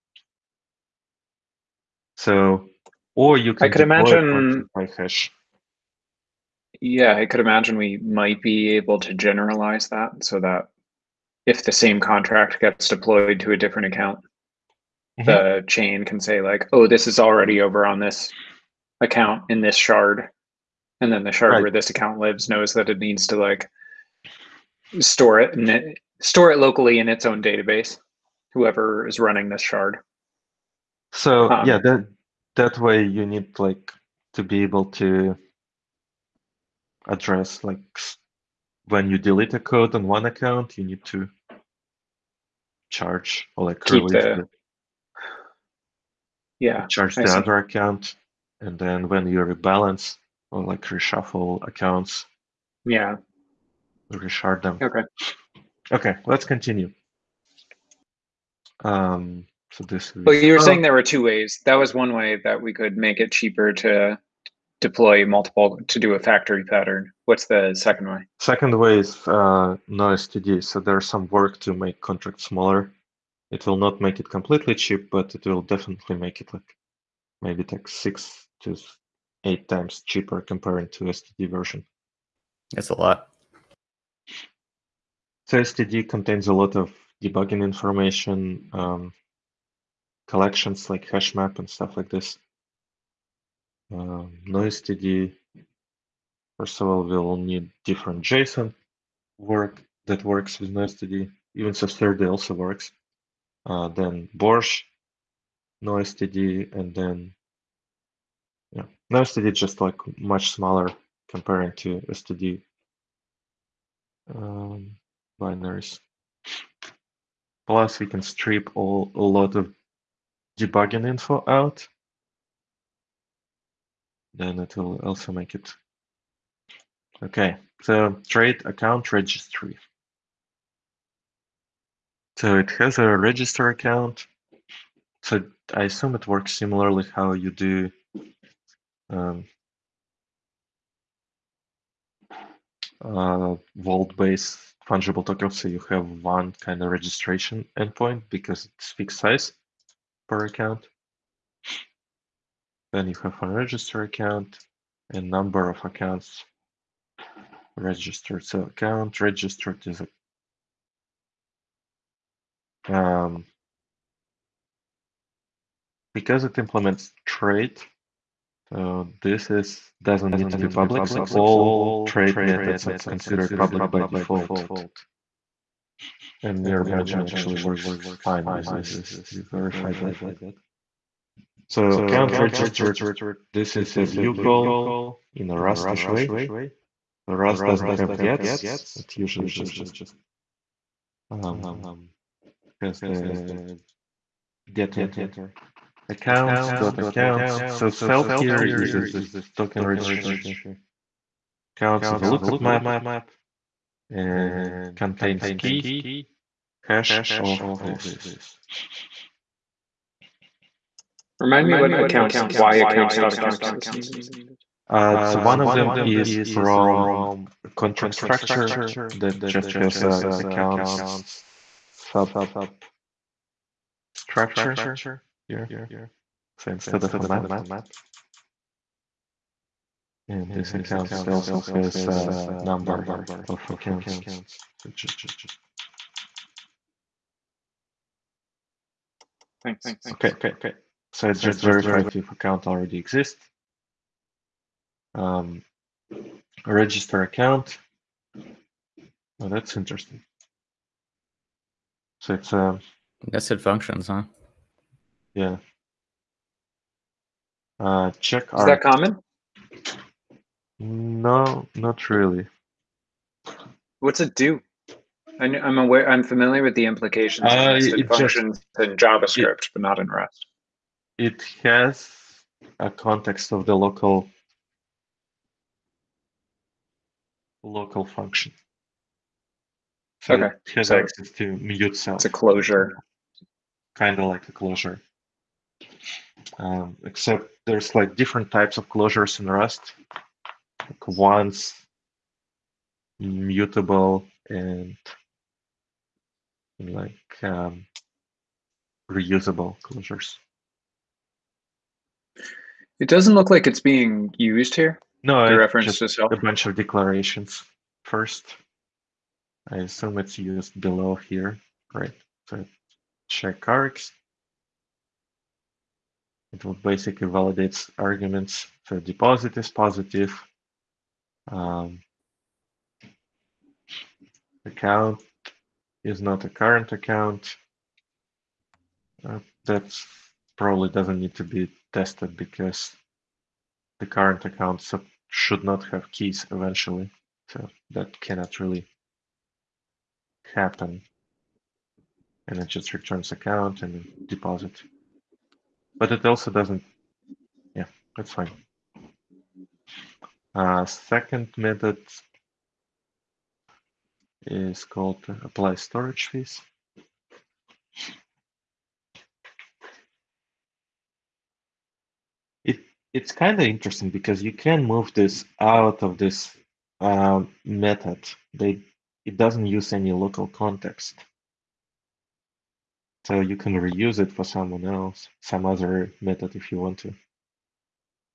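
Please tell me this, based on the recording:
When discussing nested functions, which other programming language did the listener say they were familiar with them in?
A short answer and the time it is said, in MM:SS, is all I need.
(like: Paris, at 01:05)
JavaScript, at 04:28.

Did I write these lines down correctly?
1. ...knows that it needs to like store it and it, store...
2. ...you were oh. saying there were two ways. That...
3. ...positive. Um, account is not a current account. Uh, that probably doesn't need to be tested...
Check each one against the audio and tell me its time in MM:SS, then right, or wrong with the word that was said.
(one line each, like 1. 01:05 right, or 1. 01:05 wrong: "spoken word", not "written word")
1. 00:22 right
2. 01:00 right
3. 05:19 right.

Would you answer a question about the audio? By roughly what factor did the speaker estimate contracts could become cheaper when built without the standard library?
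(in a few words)
6 to 8 times.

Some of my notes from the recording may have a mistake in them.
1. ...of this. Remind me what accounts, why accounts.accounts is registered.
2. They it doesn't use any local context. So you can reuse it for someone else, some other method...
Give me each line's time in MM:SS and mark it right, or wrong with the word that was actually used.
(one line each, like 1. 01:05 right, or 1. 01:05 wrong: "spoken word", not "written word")
1. 03:27 wrong: "needed", not "registered"
2. 06:08 right.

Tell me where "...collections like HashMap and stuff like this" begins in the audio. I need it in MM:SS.
01:30.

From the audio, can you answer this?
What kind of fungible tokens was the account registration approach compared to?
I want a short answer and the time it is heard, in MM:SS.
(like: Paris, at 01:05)
vault-based fungible tokens, at 02:23.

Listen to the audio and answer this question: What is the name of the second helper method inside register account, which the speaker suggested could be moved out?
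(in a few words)
apply storage fees.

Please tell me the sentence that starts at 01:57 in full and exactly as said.
Plus, we can strip all a lot of debugging info out, then it will also make it.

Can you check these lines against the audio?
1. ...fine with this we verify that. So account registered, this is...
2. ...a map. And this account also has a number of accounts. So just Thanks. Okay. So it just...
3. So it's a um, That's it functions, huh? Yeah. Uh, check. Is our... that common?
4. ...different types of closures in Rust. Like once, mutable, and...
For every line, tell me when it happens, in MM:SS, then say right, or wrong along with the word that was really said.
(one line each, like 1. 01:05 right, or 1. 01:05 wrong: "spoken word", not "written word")
1. 02:58 right
2. 03:47 right
3. 04:12 right
4. 04:48 right.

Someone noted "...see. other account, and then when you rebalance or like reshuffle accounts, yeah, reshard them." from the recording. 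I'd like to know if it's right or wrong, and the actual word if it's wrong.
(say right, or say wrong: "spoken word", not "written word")
right.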